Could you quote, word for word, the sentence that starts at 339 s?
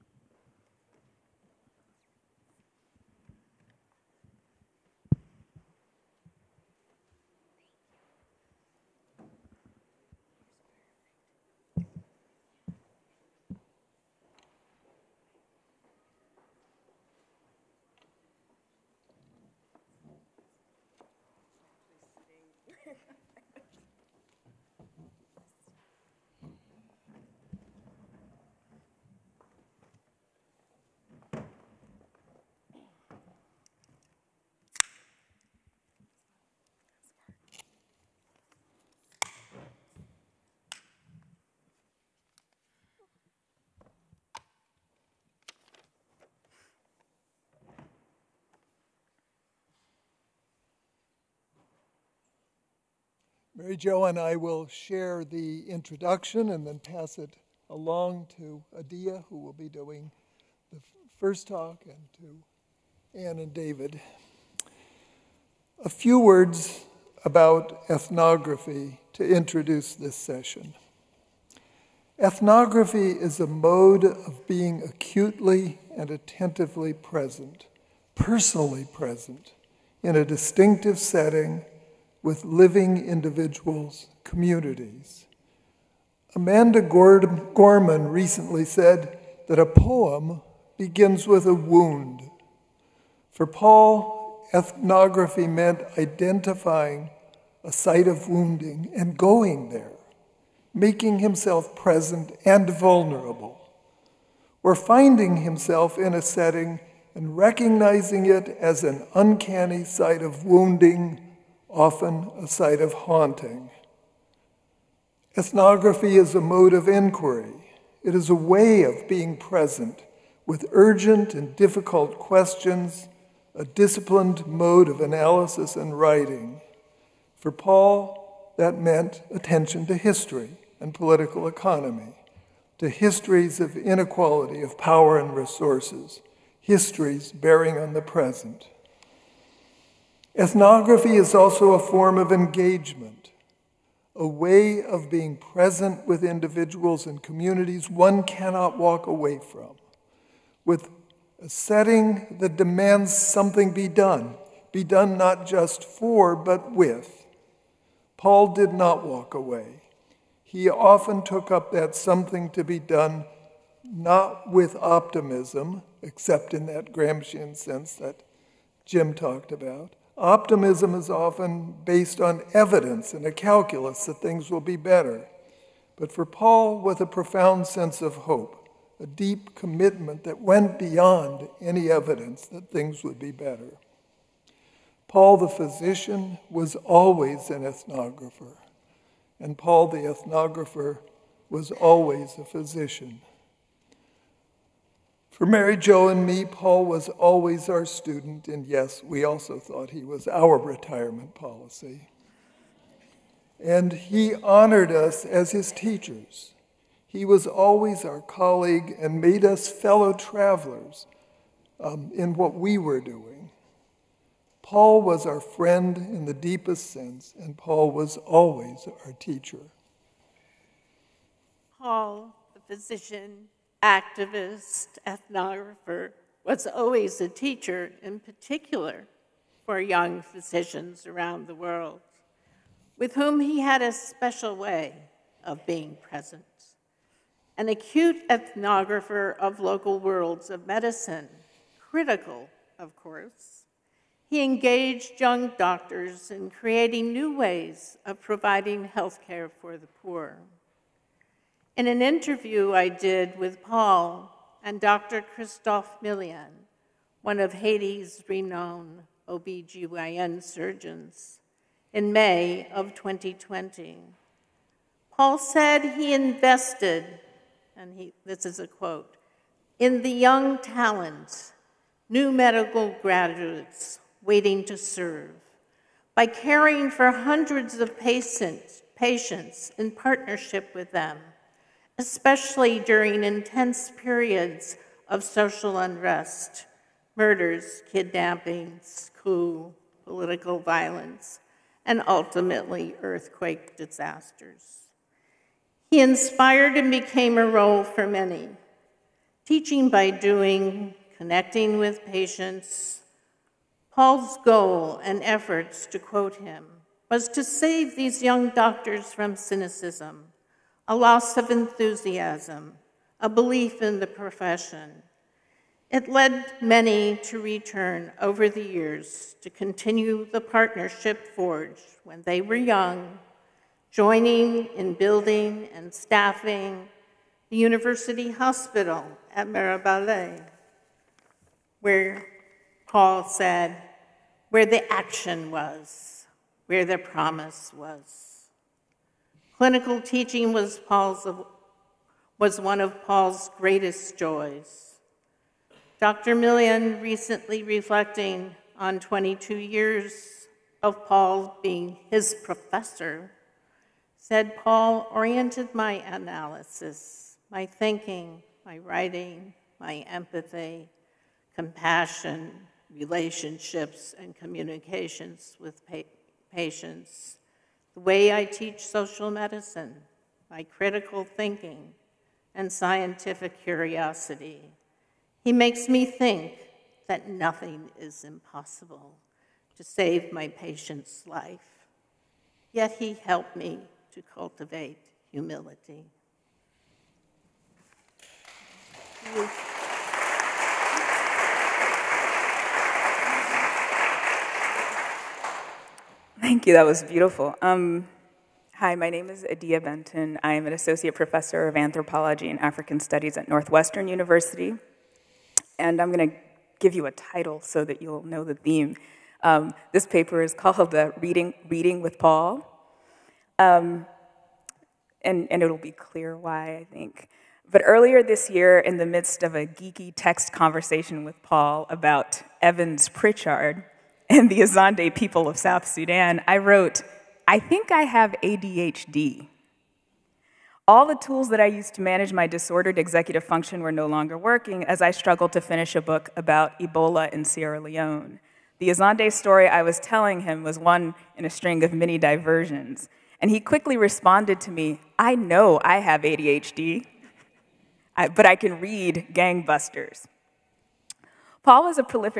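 Clinical teaching was, Paul's, was one of Paul's greatest joys.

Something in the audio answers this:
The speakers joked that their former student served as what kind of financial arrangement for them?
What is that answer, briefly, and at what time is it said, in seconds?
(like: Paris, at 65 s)
Retirement policy, at 200 s.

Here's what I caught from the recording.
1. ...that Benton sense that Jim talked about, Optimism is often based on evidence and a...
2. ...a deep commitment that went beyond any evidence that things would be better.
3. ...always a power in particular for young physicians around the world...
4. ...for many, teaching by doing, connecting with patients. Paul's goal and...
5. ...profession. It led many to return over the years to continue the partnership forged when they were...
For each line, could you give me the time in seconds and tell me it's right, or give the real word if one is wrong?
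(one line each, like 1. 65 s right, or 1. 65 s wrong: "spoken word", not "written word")
1. 166 s wrong: "Gramscian", not "Benton"
2. 178 s right
3. 226 s wrong: "teacher", not "power"
4. 297 s right
5. 314 s right.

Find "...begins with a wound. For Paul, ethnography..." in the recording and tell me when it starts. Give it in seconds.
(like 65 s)
90 s.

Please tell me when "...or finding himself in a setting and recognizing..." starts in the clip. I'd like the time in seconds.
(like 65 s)
104 s.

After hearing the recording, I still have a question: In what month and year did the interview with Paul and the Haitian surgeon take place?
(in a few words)
May 2020.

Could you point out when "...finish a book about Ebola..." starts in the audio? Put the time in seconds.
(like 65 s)
435 s.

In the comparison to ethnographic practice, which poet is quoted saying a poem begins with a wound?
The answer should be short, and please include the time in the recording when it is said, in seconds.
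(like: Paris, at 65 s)
Amanda Gorman, at 86 s.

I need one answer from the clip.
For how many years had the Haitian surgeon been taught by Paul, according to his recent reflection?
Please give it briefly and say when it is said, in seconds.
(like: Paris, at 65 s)
22, at 348 s.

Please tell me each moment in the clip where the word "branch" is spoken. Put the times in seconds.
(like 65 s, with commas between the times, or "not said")
not said.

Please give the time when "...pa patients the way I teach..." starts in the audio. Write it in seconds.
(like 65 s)
365 s.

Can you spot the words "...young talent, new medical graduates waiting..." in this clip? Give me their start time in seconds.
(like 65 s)
270 s.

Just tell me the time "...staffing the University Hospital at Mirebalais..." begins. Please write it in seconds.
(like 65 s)
325 s.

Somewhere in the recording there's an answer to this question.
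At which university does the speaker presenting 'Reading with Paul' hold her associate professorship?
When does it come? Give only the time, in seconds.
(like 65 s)
403 s.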